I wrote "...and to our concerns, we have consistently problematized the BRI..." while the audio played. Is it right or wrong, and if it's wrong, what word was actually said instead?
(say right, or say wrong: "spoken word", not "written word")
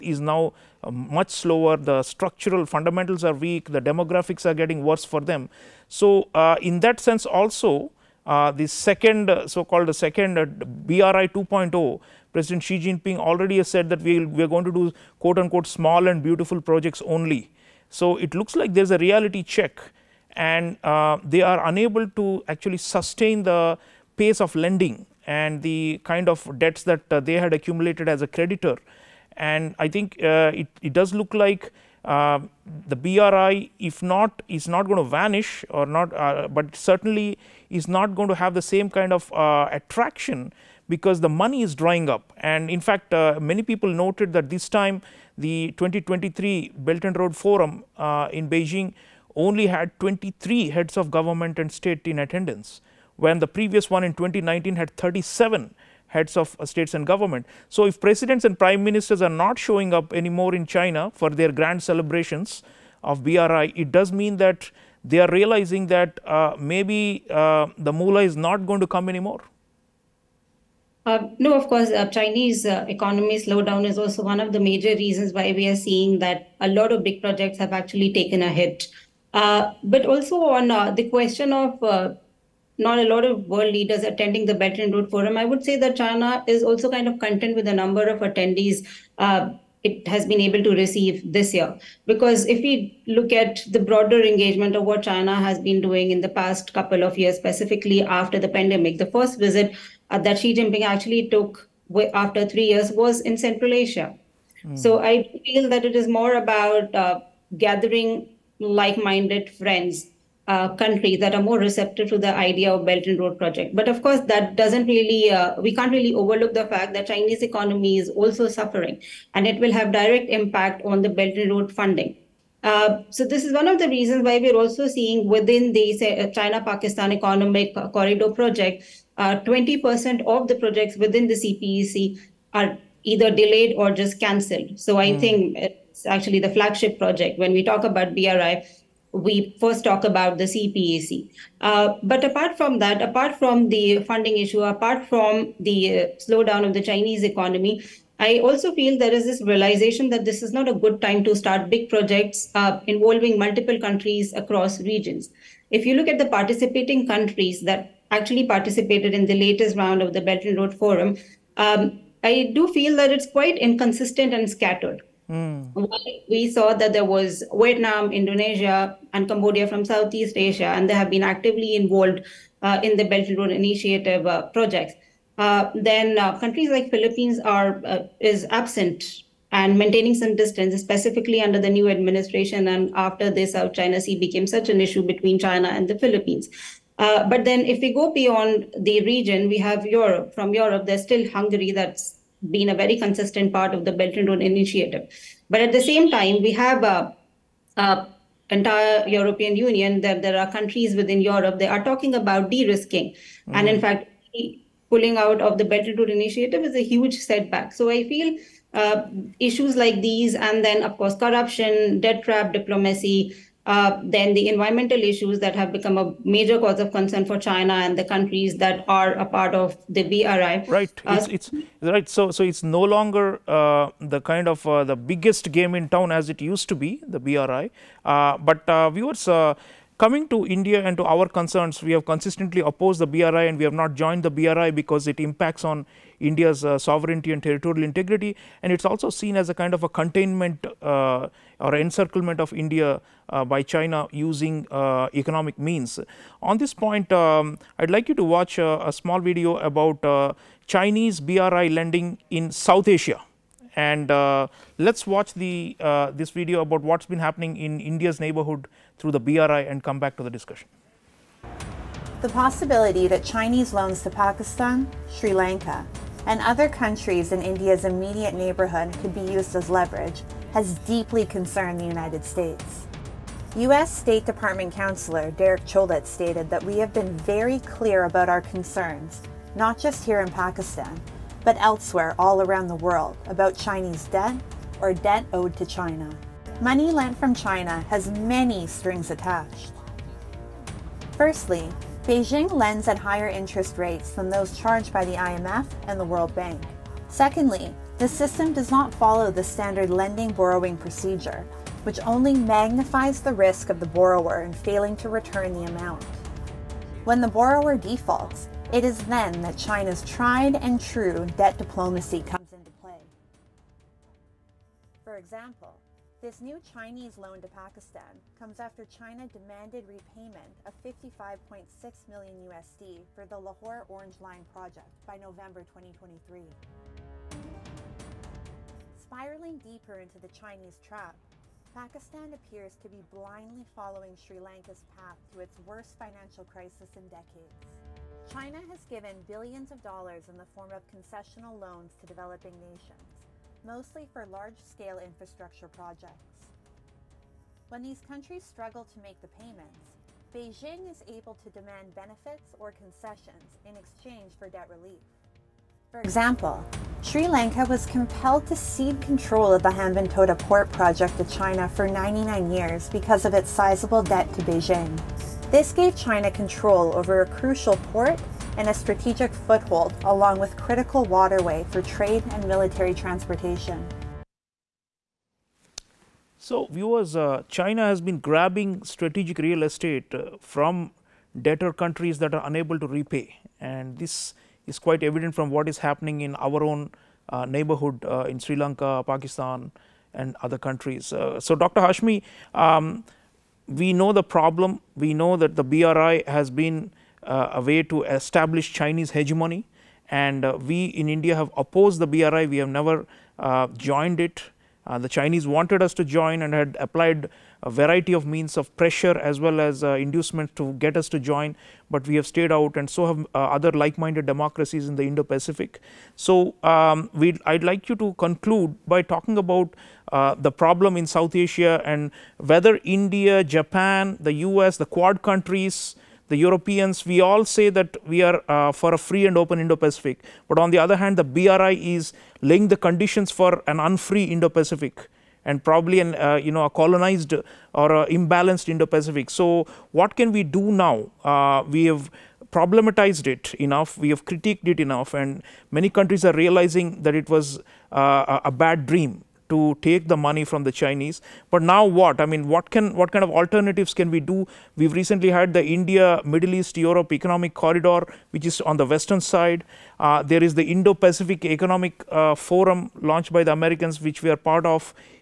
wrong: "opposed", not "problematized".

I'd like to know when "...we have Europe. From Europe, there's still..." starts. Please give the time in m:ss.
3:09.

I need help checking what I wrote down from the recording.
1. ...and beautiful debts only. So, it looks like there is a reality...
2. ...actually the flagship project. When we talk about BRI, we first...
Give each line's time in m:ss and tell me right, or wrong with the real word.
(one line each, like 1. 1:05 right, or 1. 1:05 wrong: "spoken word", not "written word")
1. 0:16 wrong: "projects", not "debts"
2. 2:16 right.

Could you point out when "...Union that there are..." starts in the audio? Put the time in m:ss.
3:19.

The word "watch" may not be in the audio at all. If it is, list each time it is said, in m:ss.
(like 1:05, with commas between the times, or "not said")
4:08, 4:15.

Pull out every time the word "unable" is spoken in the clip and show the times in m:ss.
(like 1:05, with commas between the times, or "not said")
0:21, 6:22.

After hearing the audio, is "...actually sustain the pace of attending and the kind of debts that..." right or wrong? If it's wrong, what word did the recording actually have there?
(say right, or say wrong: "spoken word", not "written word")
wrong: "lending", not "attending".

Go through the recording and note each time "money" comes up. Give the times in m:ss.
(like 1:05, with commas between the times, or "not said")
0:41, 4:46, 7:30.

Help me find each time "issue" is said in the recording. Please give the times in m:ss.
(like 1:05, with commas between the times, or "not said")
2:24, 3:04, 3:29, 3:35.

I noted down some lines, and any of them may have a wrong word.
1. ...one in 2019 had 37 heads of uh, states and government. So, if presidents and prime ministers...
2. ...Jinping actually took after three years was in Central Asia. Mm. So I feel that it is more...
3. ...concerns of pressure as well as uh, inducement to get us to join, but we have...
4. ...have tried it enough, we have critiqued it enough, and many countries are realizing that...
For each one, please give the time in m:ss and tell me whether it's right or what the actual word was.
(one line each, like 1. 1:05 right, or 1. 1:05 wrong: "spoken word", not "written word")
1. 0:53 right
2. 1:40 right
3. 6:48 wrong: "means", not "concerns"
4. 7:21 wrong: "problematized", not "tried".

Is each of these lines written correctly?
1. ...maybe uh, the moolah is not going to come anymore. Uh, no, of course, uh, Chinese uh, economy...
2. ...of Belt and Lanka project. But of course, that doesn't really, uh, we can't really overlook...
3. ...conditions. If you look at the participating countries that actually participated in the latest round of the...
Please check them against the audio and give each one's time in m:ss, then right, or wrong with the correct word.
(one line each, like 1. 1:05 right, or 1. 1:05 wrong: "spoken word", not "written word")
1. 1:06 right
2. 1:52 wrong: "Road", not "Lanka"
3. 2:34 wrong: "regions", not "conditions".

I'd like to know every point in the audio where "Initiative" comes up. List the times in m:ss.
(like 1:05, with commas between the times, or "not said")
2:53, 3:14, 3:26.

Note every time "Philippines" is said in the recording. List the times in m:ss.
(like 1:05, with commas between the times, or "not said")
2:56, 3:05.